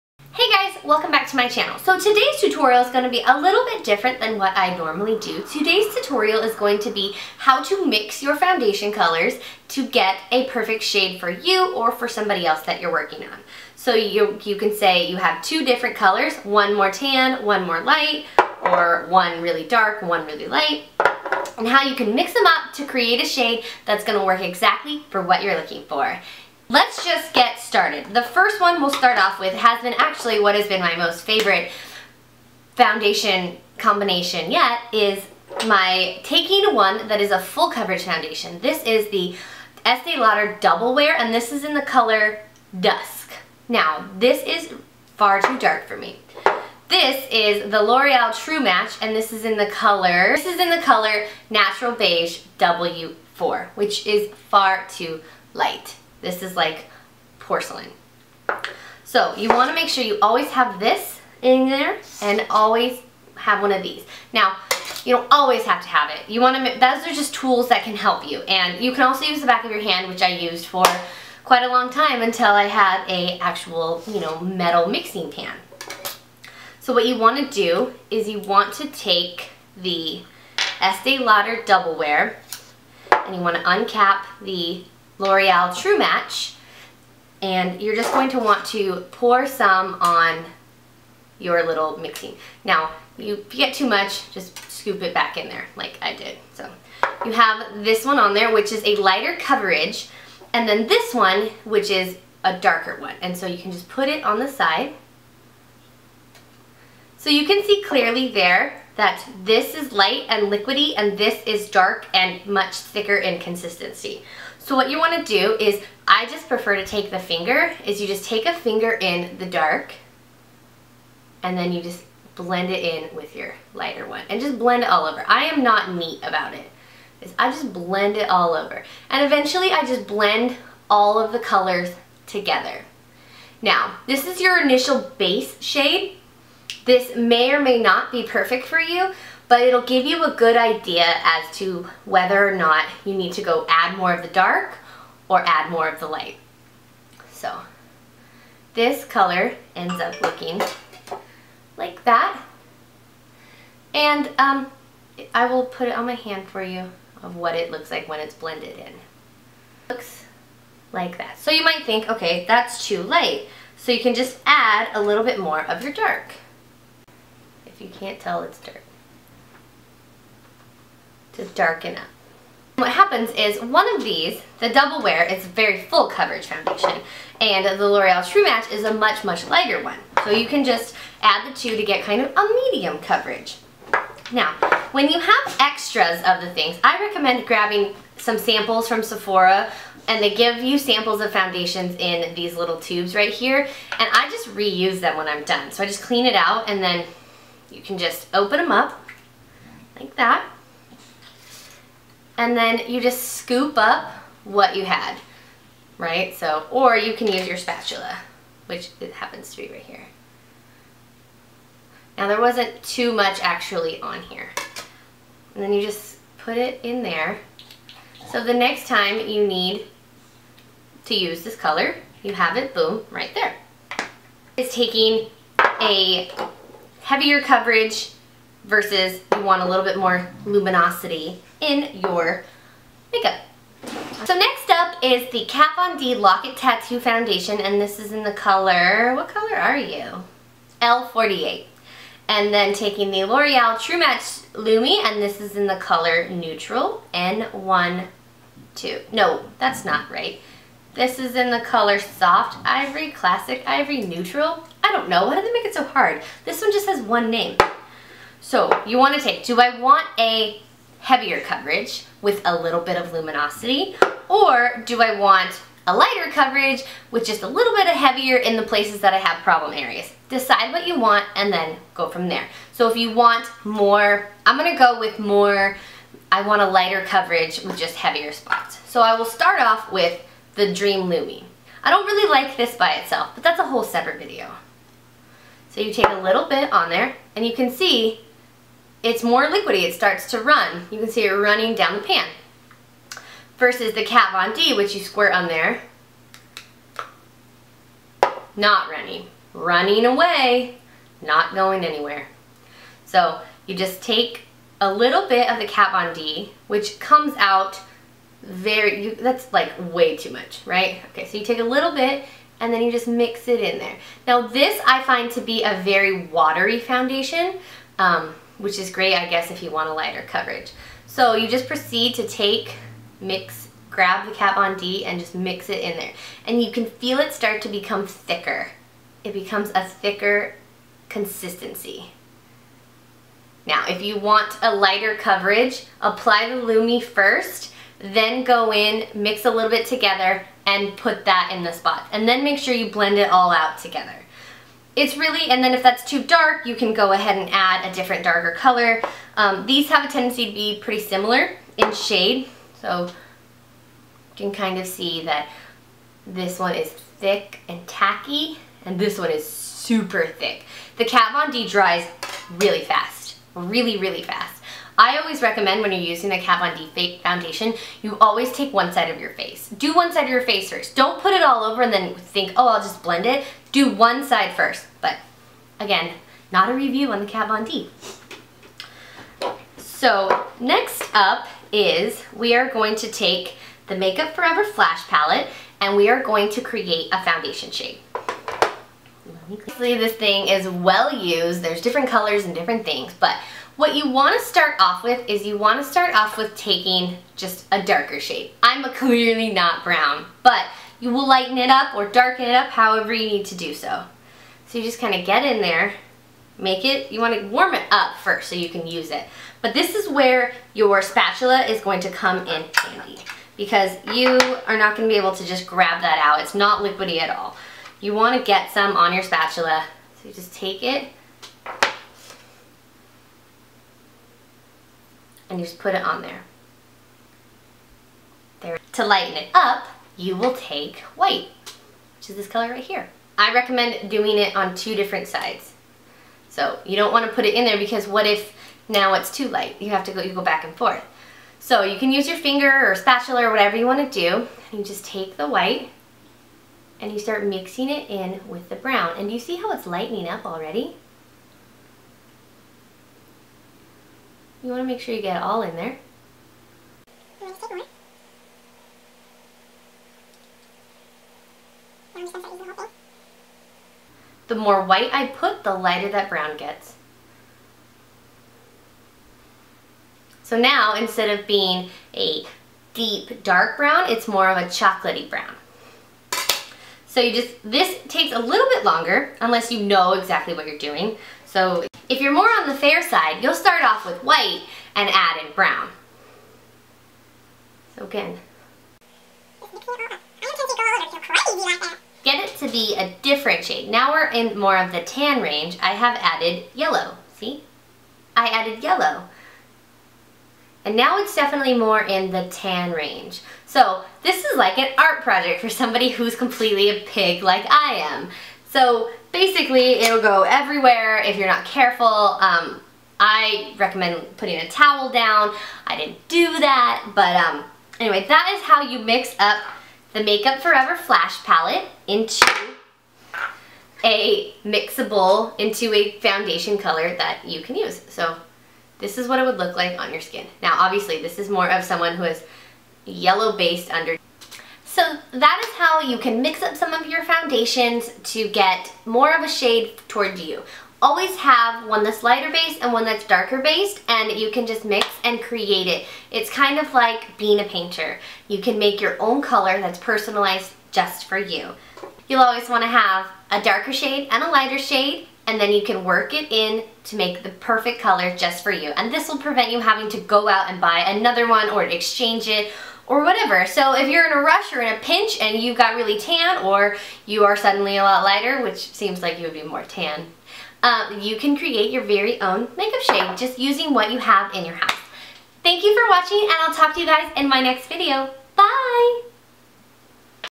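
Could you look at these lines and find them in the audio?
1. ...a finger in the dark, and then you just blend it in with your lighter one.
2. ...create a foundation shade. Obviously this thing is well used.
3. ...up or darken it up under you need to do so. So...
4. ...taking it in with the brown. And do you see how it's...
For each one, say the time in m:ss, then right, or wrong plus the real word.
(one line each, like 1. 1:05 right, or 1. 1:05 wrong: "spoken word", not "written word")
1. 1:58 right
2. 6:26 right
3. 6:41 wrong: "however", not "under"
4. 7:27 wrong: "mixing", not "taking".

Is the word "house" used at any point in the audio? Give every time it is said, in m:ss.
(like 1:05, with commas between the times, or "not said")
9:34.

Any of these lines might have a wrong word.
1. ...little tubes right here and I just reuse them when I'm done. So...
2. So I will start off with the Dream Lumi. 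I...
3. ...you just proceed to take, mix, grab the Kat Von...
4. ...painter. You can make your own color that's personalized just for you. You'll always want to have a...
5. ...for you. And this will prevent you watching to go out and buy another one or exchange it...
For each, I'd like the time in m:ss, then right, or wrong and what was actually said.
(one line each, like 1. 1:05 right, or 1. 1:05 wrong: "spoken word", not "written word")
1. 3:12 right
2. 4:38 right
3. 5:21 right
4. 9:07 right
5. 9:18 wrong: "having", not "watching".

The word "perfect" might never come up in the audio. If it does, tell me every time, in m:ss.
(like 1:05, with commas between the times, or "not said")
0:10, 2:18, 9:17.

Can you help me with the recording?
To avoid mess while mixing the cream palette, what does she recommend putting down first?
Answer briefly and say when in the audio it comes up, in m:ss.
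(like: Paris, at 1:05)
a towel, at 8:34.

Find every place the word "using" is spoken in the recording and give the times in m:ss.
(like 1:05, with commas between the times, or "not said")
6:05, 9:33.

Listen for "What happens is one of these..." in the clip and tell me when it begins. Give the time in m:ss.
2:52.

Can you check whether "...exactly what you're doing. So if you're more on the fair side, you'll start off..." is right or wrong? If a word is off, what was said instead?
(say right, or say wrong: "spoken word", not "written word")
right.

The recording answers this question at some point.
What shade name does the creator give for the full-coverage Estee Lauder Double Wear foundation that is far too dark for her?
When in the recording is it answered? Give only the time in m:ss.
0:42.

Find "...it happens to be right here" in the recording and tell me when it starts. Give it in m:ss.
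3:28.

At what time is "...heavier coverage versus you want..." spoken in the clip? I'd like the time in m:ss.
3:47.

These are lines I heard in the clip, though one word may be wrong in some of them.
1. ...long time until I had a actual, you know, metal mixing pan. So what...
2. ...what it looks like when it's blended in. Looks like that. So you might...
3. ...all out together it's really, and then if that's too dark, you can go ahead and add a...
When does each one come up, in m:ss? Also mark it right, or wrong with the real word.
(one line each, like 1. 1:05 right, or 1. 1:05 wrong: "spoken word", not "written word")
1. 1:11 right
2. 2:37 right
3. 5:43 right.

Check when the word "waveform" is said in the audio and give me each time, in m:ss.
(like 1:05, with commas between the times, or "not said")
not said.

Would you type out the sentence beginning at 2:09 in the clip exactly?
And eventually I just blend all of the colors together.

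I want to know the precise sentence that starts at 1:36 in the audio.
So you have this one on there, which is a lighter coverage, and then this one, which is a darker one.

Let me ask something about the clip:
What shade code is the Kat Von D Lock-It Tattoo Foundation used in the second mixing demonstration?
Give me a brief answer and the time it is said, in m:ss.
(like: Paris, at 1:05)
L48, at 4:00.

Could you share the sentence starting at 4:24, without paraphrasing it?
Or do I want a lighter coverage with just a little bit of heavier in the places that I have problem areas?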